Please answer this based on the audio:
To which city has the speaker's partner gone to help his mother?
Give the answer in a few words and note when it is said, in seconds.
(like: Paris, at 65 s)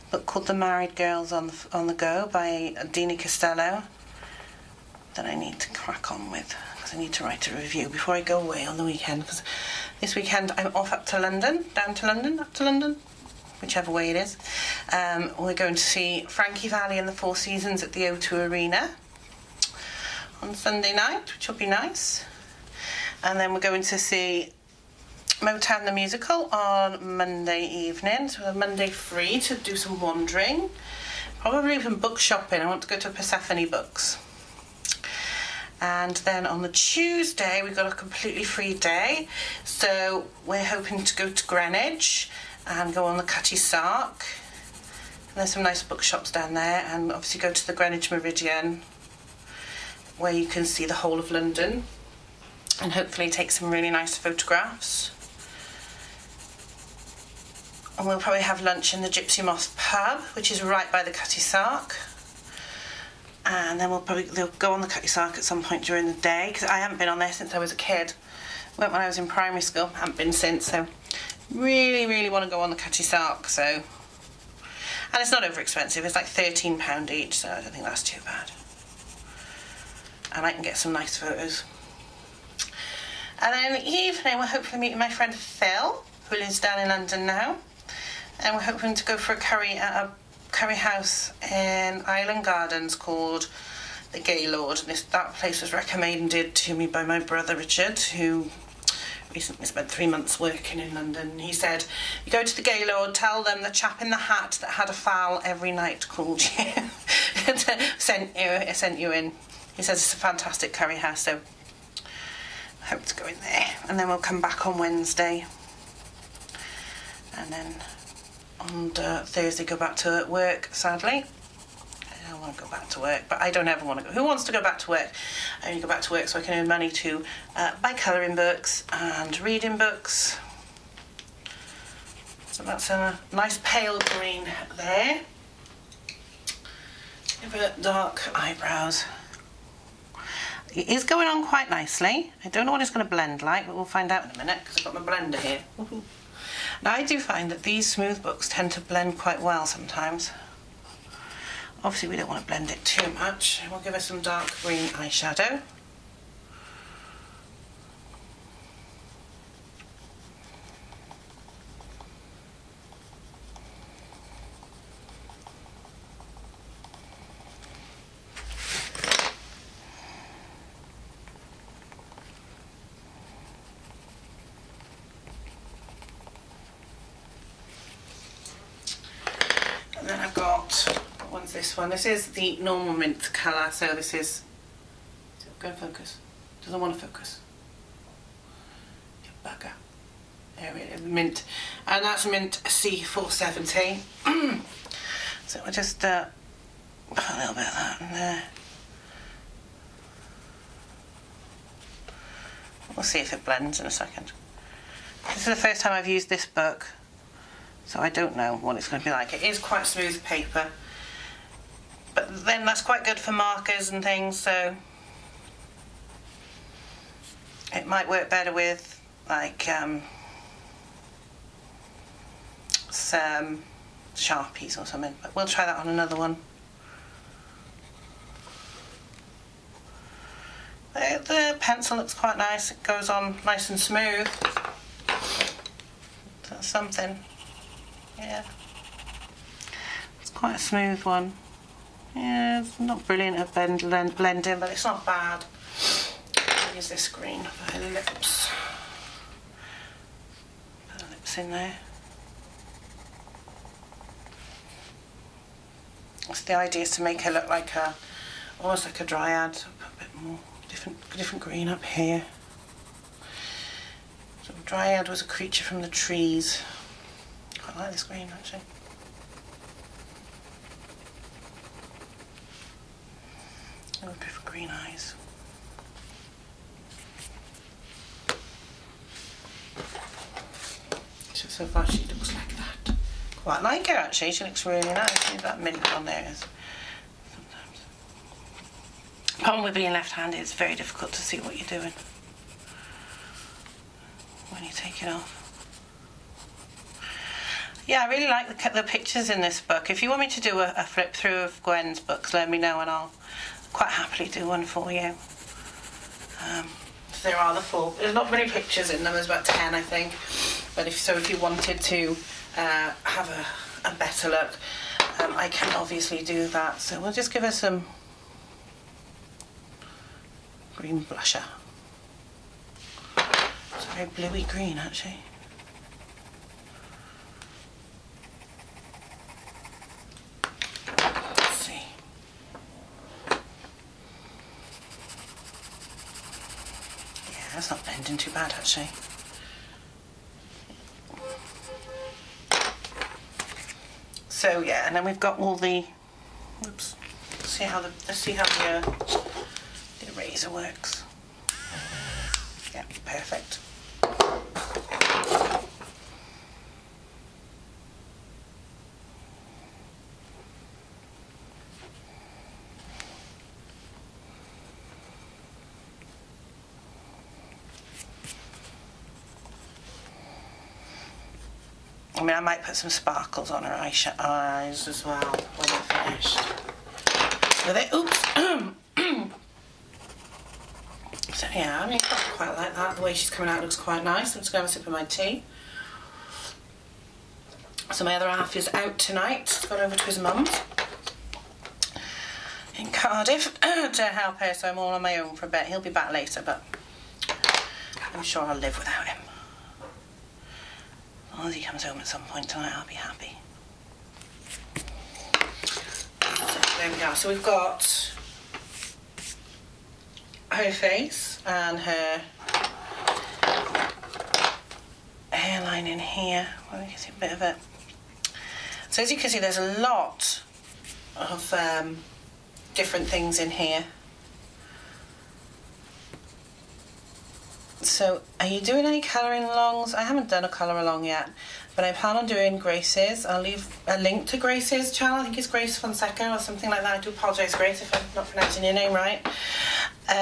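Cardiff, at 392 s.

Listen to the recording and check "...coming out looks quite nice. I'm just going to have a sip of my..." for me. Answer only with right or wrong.
right.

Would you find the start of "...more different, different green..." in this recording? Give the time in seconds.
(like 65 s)
260 s.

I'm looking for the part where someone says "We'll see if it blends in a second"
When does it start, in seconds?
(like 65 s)
202 s.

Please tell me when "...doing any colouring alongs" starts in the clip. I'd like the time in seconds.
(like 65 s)
428 s.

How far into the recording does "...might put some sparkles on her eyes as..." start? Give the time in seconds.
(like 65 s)
372 s.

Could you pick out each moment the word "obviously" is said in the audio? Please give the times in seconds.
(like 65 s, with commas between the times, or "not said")
47 s, 151 s, 315 s.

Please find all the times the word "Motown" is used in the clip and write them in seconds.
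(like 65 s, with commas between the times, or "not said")
25 s.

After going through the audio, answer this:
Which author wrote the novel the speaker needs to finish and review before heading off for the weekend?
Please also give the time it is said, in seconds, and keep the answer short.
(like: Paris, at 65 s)
Diney Costeloe, at 2 s.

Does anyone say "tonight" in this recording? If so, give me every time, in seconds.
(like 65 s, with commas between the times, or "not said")
388 s, 402 s.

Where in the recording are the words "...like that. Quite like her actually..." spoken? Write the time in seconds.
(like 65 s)
282 s.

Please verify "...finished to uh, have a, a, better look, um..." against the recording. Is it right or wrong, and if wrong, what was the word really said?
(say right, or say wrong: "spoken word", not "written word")
wrong: "wanted", not "finished".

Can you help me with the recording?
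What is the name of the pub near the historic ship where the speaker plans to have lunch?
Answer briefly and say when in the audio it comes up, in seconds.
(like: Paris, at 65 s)
Gypsy Moth, at 59 s.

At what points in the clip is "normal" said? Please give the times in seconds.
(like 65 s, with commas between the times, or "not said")
182 s.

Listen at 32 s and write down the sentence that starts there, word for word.
I want to go to Persephone Books.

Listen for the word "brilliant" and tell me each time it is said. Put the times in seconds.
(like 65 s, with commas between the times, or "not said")
243 s.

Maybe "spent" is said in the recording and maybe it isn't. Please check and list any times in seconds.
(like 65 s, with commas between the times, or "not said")
99 s.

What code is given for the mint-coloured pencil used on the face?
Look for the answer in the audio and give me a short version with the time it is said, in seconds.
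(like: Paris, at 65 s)
C470, at 192 s.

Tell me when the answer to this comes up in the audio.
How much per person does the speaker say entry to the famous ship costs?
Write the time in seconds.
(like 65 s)
76 s.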